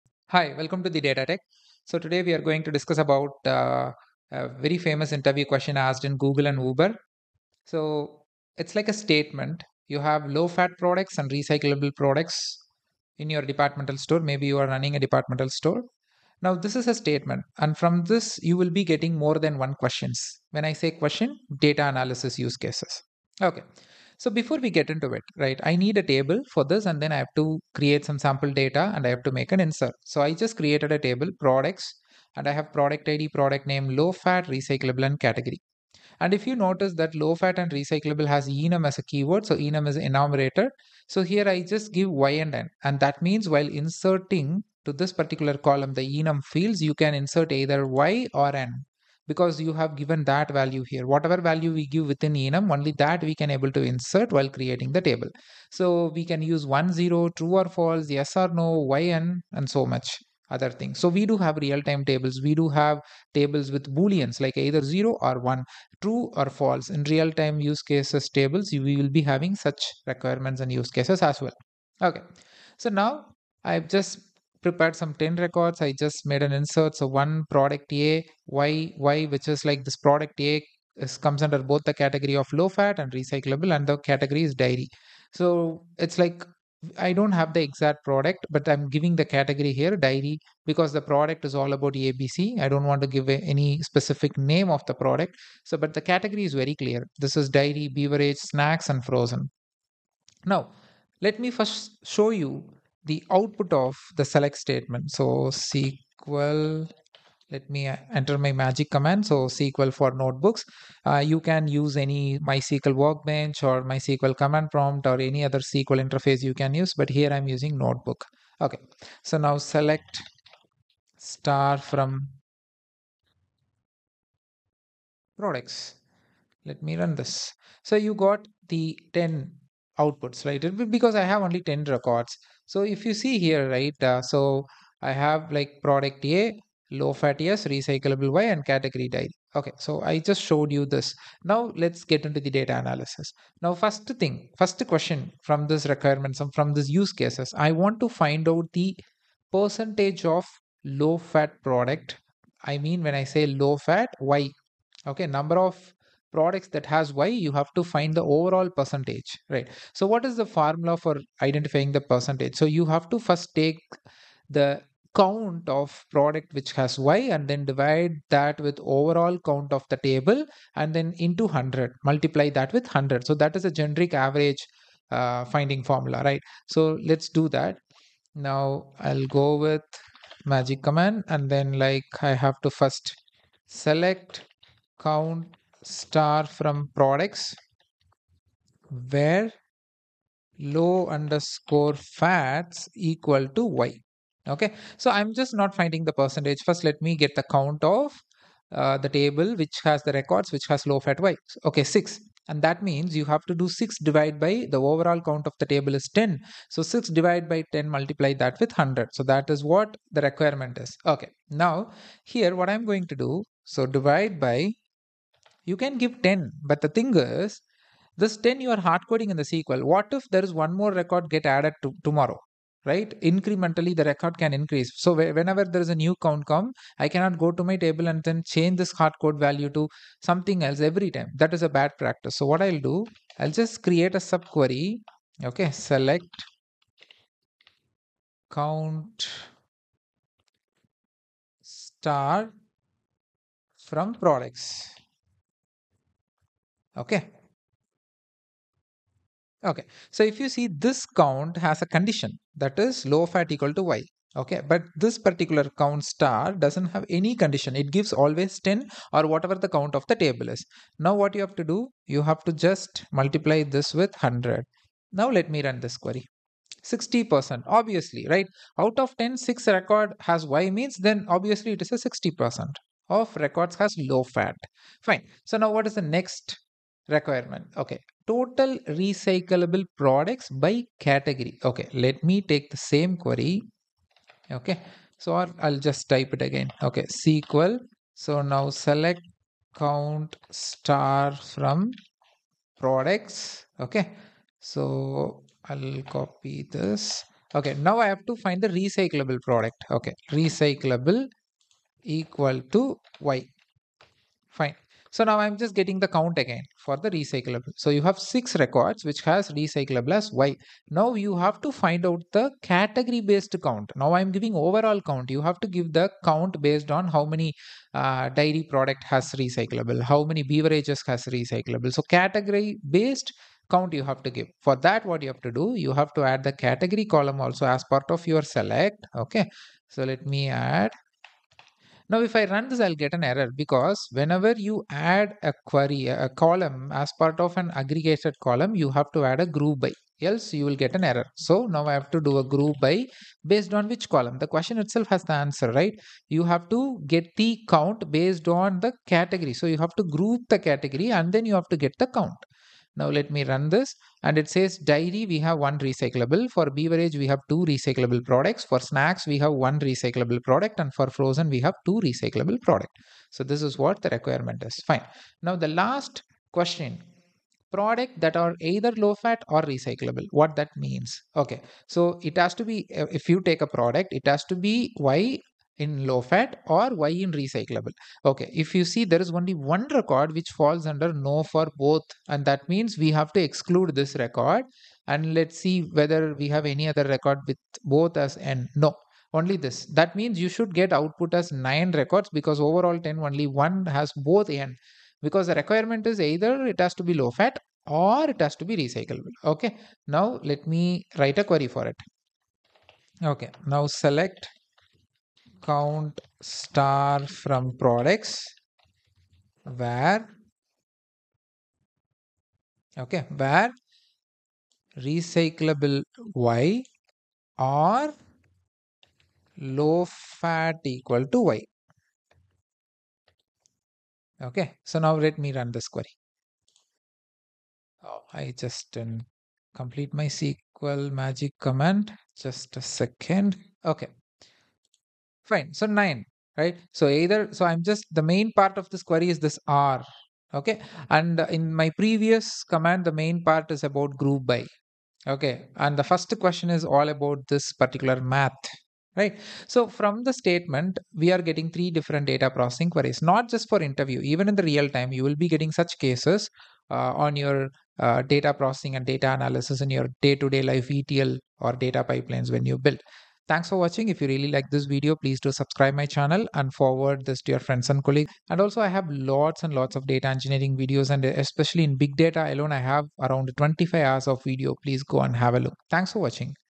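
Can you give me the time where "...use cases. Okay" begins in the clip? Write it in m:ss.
0:22.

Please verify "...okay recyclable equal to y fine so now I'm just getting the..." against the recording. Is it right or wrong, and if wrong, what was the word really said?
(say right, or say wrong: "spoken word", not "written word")
right.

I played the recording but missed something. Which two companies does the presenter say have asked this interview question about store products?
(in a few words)
Google and Uber.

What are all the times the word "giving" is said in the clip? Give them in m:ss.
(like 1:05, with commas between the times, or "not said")
1:28, 5:14.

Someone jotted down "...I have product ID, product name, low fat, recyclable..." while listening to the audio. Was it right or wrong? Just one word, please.
right.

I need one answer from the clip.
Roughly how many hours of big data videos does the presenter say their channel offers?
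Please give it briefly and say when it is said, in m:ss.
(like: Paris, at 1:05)
25 hours, at 7:53.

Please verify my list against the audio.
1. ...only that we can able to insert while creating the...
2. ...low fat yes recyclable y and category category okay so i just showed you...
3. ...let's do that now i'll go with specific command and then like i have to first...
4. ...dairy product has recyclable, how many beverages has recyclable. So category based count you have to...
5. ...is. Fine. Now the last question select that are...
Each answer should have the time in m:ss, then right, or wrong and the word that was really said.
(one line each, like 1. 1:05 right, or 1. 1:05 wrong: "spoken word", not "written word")
1. 0:52 right
2. 2:17 wrong: "dairy", not "category"
3. 2:57 wrong: "magic", not "specific"
4. 5:18 right
5. 6:04 wrong: "product", not "select".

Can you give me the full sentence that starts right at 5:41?
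So now I have to do a group by based on which column.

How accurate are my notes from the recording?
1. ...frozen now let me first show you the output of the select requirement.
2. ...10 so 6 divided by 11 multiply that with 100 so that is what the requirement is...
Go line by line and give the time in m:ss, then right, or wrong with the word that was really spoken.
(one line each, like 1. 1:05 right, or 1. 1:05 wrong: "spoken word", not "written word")
1. 1:39 wrong: "statement", not "requirement"
2. 3:26 wrong: "10", not "11".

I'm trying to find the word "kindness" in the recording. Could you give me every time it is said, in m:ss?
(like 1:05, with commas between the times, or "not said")
not said.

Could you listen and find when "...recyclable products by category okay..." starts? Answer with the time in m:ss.
4:39.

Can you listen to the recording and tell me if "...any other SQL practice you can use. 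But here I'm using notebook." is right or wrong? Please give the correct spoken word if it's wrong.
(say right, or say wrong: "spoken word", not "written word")
wrong: "interface", not "practice".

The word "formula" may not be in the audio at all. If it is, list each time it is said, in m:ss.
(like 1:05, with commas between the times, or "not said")
2:40, 2:55.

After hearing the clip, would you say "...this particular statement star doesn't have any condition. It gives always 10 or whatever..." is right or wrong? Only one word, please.
wrong.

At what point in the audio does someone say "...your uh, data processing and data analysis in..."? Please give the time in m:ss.
7:37.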